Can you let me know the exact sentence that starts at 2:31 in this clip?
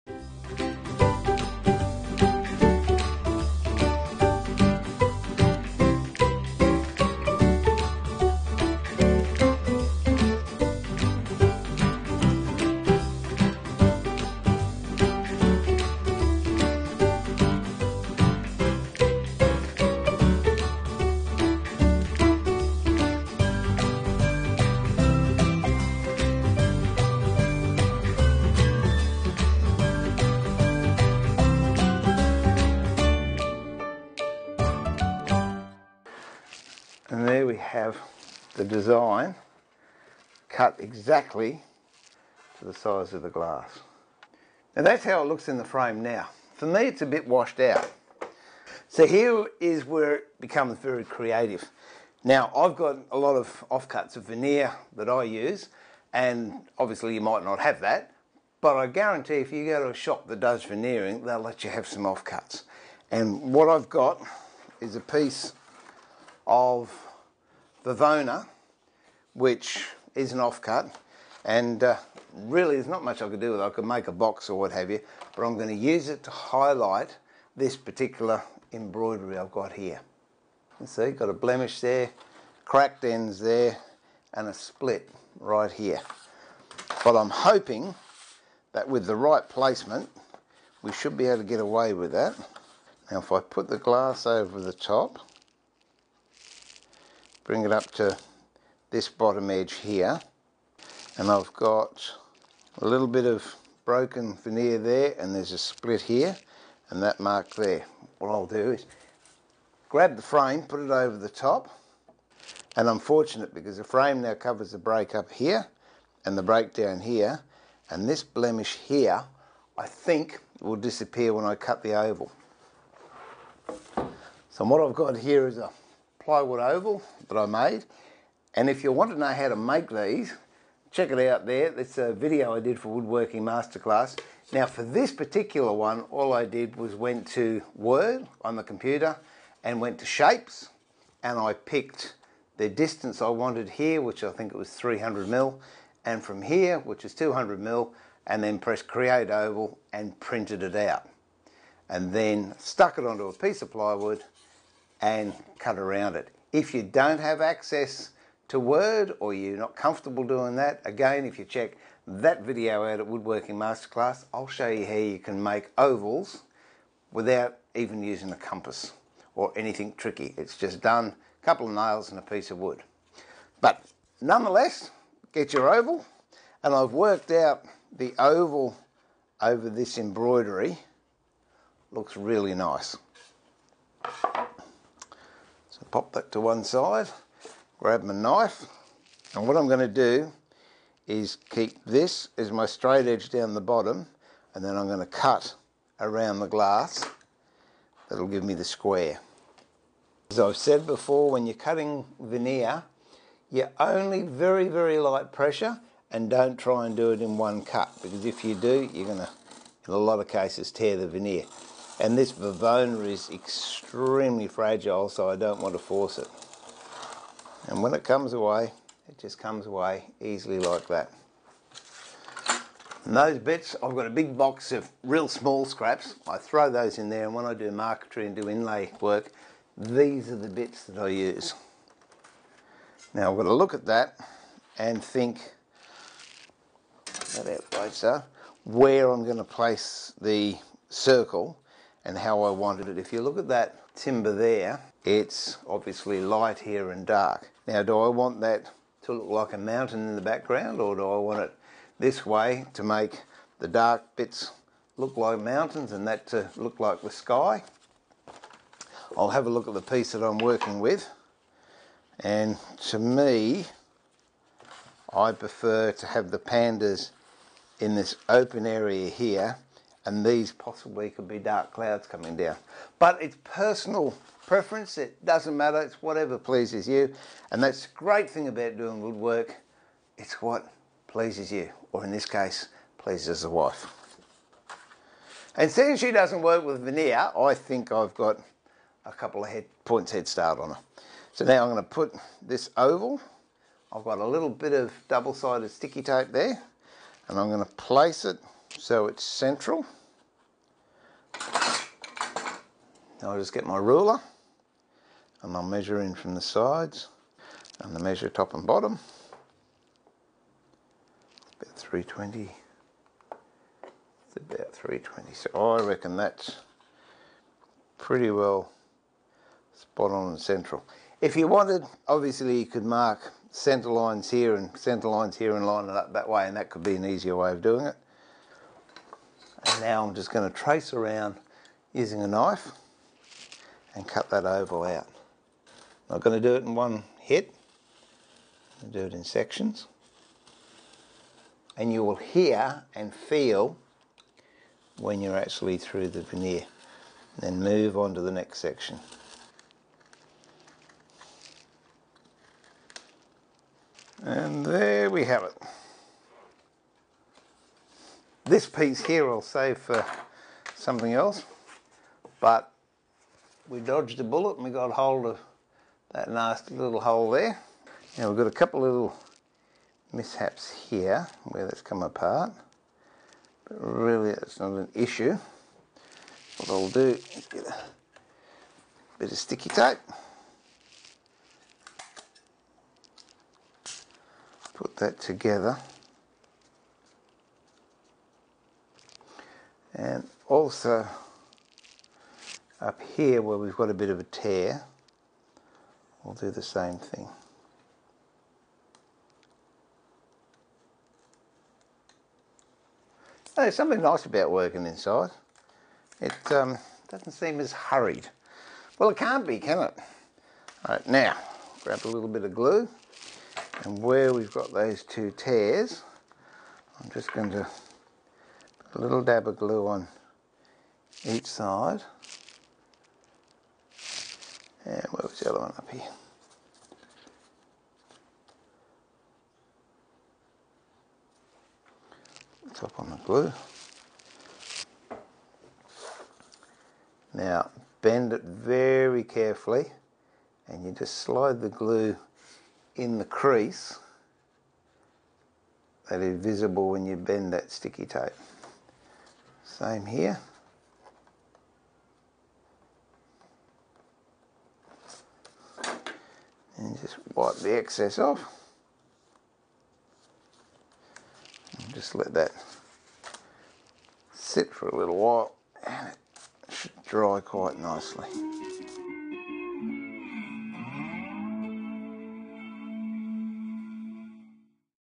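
And then stuck it onto a piece of plywood and cut around it.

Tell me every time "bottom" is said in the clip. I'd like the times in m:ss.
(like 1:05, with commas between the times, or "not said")
1:39, 3:13, 5:08.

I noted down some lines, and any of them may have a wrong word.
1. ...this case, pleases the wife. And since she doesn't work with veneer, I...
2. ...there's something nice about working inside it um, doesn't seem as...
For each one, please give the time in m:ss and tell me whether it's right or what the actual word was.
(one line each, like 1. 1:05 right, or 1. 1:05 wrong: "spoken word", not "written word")
1. 4:42 right
2. 6:43 right.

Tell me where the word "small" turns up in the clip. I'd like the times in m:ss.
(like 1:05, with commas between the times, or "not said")
3:45.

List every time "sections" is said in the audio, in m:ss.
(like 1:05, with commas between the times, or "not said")
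5:39, 5:48.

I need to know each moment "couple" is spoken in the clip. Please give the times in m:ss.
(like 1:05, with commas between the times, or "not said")
2:51, 4:49, 6:08.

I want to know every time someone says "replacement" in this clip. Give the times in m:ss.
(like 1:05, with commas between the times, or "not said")
not said.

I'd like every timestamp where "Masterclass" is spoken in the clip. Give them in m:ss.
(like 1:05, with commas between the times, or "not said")
2:13, 2:43.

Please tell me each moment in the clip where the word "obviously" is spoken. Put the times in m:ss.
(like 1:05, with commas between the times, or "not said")
0:56, 4:05, 5:22.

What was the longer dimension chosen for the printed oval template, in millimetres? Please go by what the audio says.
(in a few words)
300 mm.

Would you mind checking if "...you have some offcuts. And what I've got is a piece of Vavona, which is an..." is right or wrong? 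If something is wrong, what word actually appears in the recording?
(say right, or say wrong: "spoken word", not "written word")
right.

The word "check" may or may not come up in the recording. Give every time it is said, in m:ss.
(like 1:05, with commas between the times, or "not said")
2:10, 2:41.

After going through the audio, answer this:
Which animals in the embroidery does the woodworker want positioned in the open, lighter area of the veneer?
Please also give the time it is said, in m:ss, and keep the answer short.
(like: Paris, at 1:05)
pandas, at 4:26.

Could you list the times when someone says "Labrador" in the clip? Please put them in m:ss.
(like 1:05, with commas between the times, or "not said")
not said.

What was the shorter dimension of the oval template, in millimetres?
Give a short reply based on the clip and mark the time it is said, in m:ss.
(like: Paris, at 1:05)
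200 mm, at 2:27.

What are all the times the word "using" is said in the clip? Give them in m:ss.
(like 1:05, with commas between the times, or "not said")
2:48, 5:31.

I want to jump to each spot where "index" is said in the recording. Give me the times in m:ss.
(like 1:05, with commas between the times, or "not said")
not said.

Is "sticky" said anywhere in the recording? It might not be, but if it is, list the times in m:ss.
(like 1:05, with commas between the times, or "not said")
4:55, 6:19, 7:27.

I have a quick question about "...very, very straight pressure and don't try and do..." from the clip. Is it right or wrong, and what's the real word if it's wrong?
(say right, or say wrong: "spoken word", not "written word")
wrong: "light", not "straight".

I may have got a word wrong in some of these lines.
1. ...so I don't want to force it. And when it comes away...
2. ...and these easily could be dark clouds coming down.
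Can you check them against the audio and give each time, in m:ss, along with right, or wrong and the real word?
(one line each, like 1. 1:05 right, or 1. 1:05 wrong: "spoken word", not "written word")
1. 3:35 right
2. 4:30 wrong: "possibly", not "easily".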